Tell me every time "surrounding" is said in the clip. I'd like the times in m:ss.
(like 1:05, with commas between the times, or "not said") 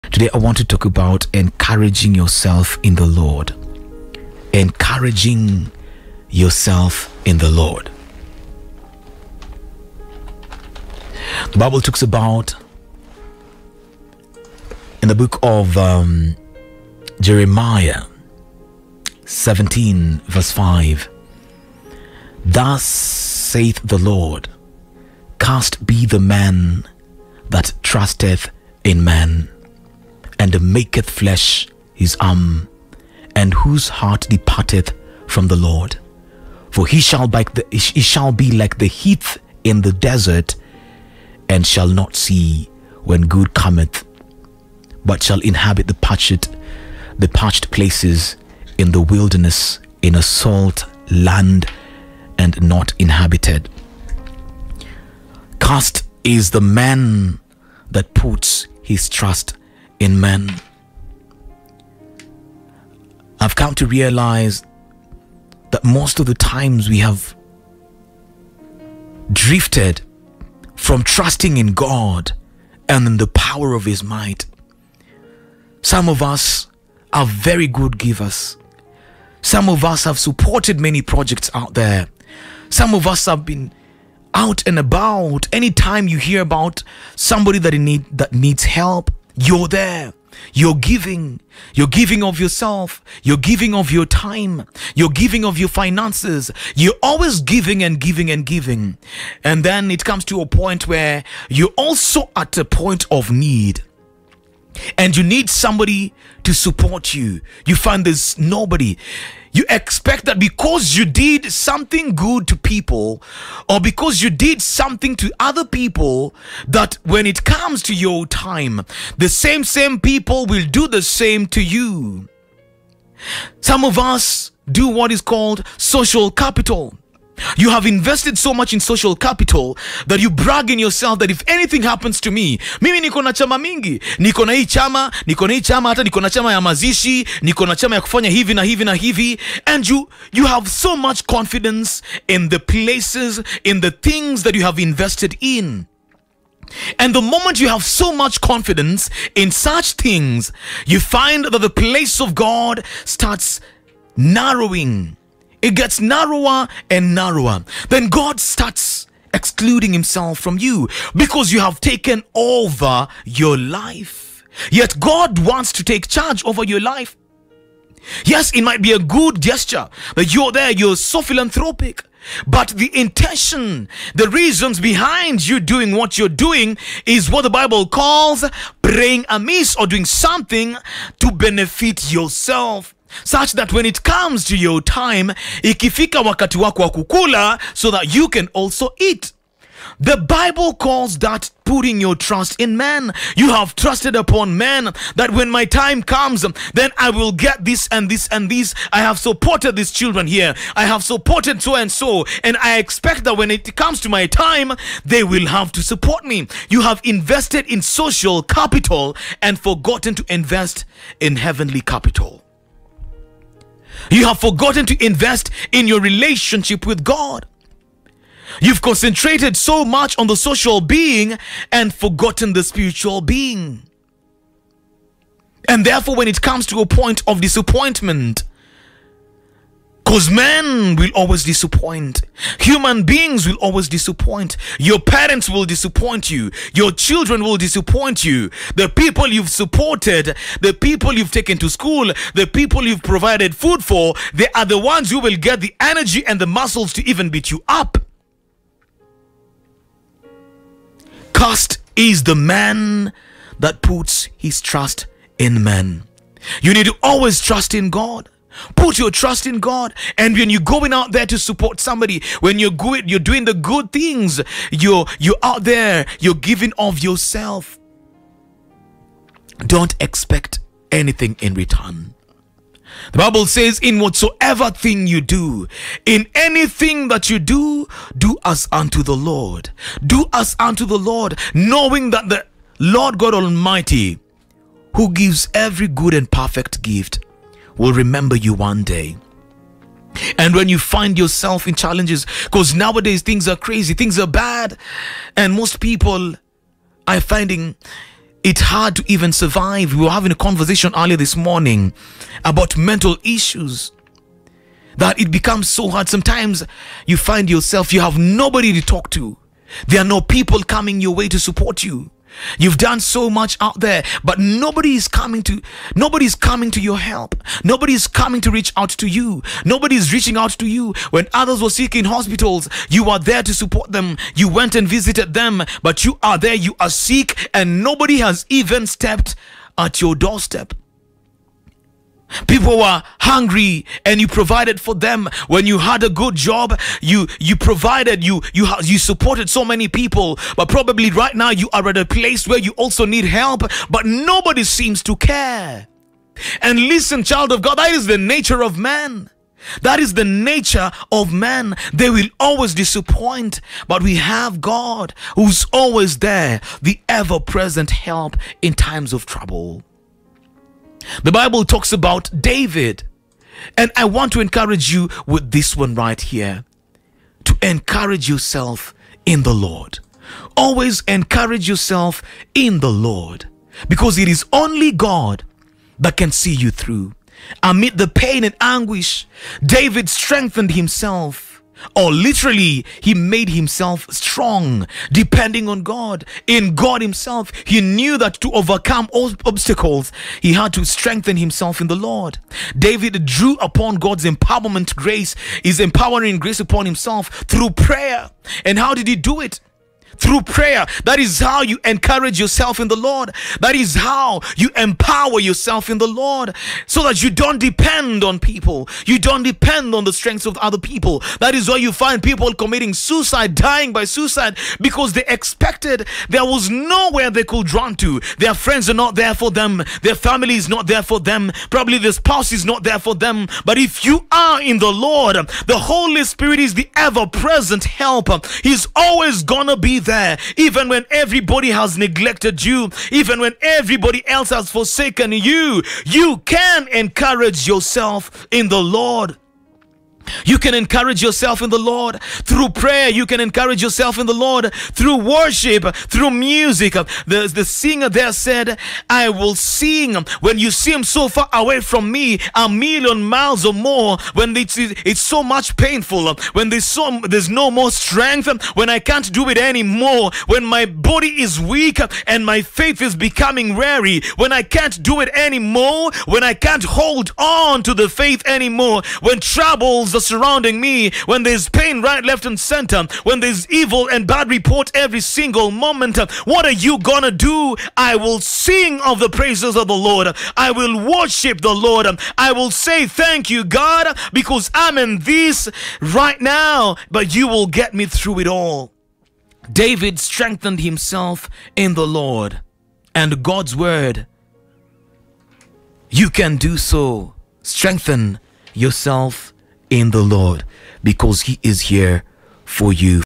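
7:50.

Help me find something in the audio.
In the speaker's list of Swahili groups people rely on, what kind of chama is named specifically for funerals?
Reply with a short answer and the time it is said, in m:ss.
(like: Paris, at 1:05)
chama ya mazishi, at 2:16.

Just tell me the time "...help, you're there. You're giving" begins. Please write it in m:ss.
1:28.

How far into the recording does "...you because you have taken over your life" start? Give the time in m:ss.
2:40.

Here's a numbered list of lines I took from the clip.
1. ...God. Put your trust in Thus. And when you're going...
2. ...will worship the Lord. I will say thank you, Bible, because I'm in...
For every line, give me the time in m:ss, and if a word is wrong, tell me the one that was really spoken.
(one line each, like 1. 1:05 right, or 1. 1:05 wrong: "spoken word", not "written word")
1. 4:17 wrong: "God", not "Thus"
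2. 8:00 wrong: "God", not "Bible".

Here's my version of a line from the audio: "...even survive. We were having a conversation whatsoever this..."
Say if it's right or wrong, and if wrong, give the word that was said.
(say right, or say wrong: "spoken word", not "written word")
wrong: "earlier", not "whatsoever".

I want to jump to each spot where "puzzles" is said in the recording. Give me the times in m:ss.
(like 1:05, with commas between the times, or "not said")
not said.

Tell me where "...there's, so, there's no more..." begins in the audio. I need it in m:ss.
7:36.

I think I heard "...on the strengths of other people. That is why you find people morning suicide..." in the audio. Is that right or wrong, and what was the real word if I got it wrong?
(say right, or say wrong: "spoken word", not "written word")
wrong: "committing", not "morning".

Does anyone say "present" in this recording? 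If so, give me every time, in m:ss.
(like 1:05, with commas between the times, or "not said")
5:57, 7:07.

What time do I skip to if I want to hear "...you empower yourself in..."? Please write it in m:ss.
6:44.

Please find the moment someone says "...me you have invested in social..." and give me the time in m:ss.
3:26.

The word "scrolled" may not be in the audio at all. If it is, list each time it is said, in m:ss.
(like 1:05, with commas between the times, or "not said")
not said.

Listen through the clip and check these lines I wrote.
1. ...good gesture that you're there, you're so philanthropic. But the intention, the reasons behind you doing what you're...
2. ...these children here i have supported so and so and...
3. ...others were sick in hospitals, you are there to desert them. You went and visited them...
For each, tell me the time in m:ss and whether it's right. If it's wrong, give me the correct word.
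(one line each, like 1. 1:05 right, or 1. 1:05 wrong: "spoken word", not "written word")
1. 2:48 right
2. 3:19 right
3. 5:21 wrong: "support", not "desert".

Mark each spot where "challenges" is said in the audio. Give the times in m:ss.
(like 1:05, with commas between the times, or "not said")
4:51.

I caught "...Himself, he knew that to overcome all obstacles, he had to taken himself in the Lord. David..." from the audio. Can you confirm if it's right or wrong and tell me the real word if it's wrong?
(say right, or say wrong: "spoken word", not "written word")
wrong: "strengthen", not "taken".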